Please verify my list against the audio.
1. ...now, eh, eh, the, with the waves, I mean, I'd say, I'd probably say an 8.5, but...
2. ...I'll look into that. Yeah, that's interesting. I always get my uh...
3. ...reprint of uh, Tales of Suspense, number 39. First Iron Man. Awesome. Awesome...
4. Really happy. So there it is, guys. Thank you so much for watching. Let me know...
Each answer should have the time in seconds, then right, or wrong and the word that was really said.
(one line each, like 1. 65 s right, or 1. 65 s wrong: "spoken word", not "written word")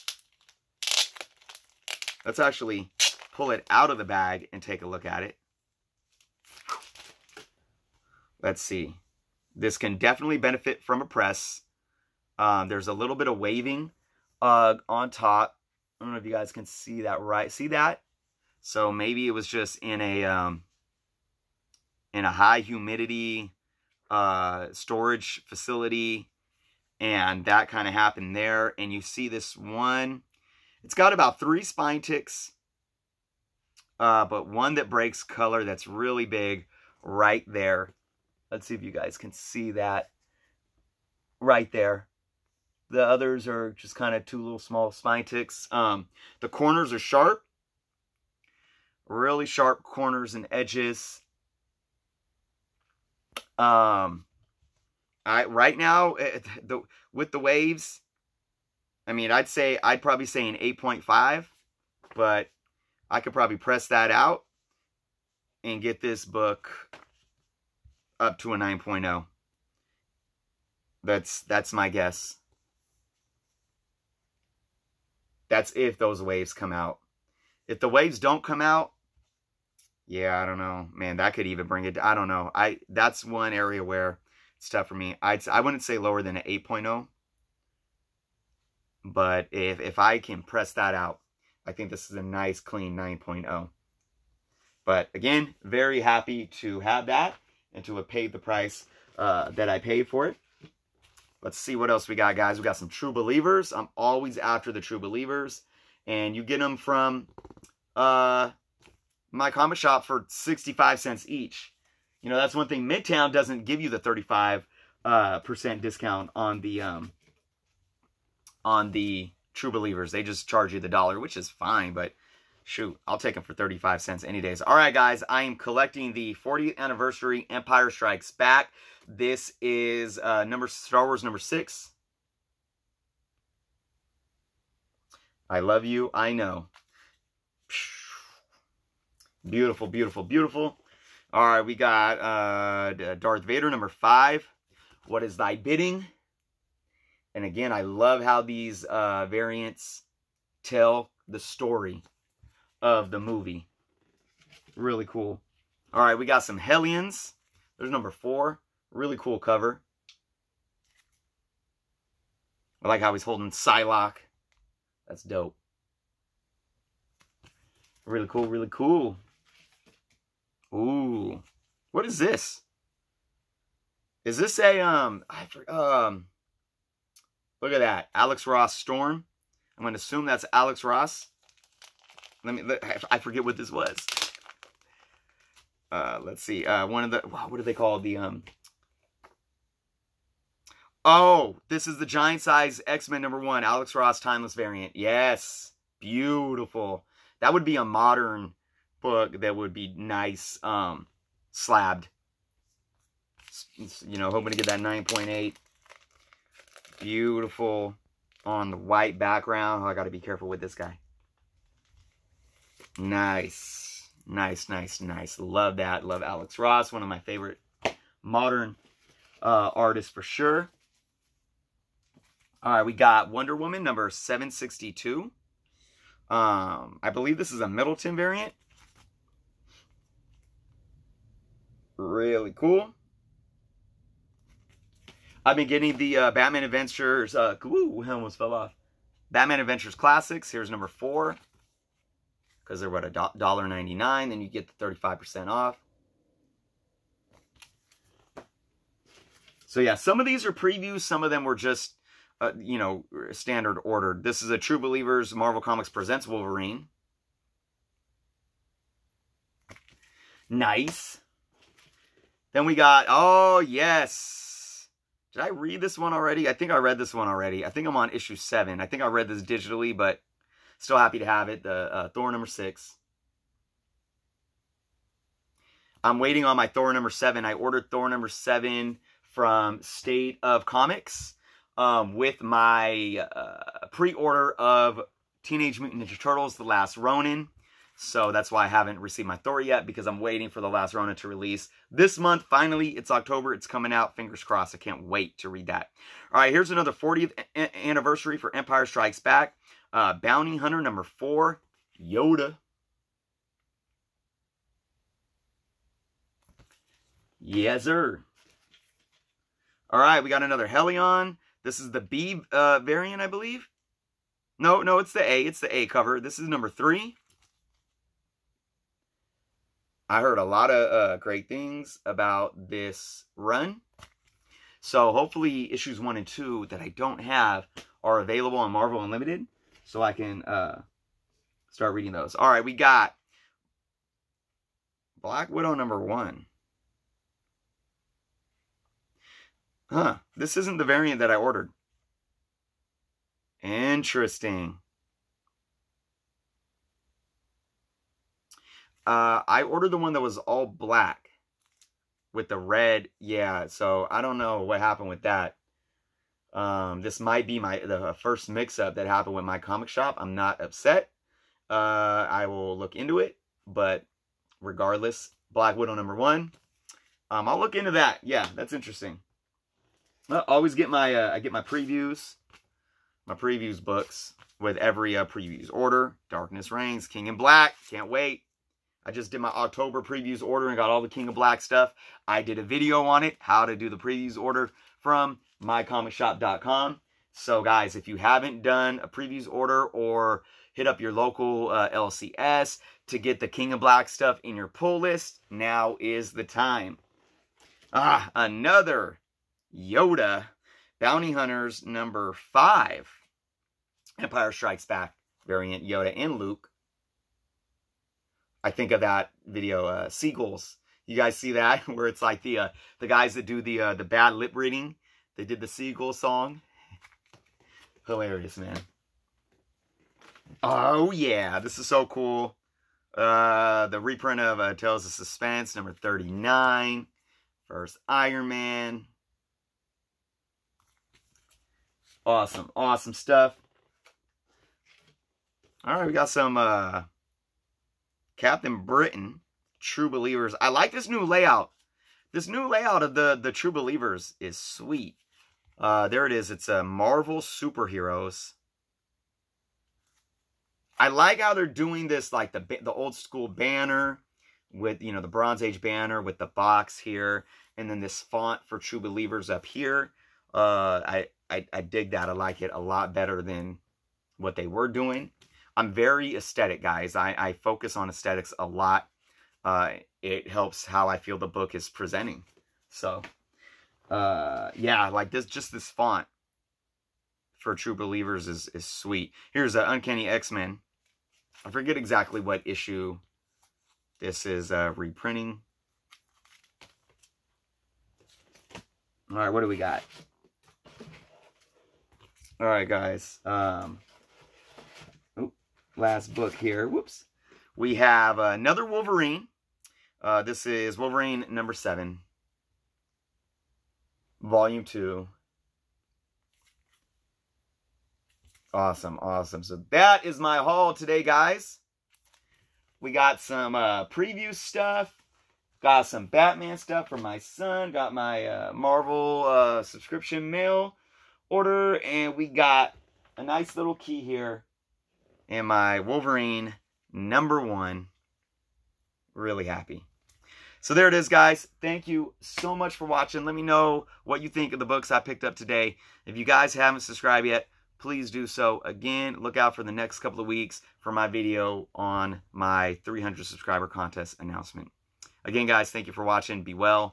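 1. 55 s right
2. 367 s right
3. 424 s right
4. 529 s right.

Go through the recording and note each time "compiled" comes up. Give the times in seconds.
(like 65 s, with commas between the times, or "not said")
not said.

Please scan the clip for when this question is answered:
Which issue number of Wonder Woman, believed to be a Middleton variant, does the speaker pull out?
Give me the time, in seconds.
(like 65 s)
224 s.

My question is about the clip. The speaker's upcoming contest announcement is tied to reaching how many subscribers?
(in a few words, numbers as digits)
300.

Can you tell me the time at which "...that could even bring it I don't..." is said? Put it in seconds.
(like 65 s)
81 s.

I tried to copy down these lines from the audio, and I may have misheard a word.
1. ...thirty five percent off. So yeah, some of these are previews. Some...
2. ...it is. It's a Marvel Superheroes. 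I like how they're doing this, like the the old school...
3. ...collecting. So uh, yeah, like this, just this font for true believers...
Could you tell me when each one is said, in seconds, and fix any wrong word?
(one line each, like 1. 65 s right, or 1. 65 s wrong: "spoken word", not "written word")
1. 244 s right
2. 446 s right
3. 471 s wrong: "presenting", not "collecting".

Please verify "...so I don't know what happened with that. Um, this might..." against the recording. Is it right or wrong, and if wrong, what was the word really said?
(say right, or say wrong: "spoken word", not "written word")
right.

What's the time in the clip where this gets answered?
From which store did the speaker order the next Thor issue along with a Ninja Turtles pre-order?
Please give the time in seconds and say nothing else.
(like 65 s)
279 s.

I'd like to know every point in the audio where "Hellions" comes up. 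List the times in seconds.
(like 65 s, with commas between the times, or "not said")
156 s, 310 s.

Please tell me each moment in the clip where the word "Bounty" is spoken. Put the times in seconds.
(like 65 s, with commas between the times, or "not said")
300 s, 400 s.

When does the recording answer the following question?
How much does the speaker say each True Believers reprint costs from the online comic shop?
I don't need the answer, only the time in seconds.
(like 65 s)
110 s.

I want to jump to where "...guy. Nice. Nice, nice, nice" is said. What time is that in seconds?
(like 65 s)
210 s.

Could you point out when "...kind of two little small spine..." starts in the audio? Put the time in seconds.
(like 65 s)
43 s.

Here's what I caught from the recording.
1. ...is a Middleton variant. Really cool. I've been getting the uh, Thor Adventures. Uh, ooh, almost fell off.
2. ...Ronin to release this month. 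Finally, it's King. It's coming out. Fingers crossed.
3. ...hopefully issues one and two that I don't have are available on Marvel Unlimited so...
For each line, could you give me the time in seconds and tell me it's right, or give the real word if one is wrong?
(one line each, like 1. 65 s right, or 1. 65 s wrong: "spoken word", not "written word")
1. 227 s wrong: "Batman", not "Thor"
2. 290 s wrong: "October", not "King"
3. 325 s right.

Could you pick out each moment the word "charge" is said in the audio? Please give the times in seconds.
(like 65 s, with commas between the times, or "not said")
120 s.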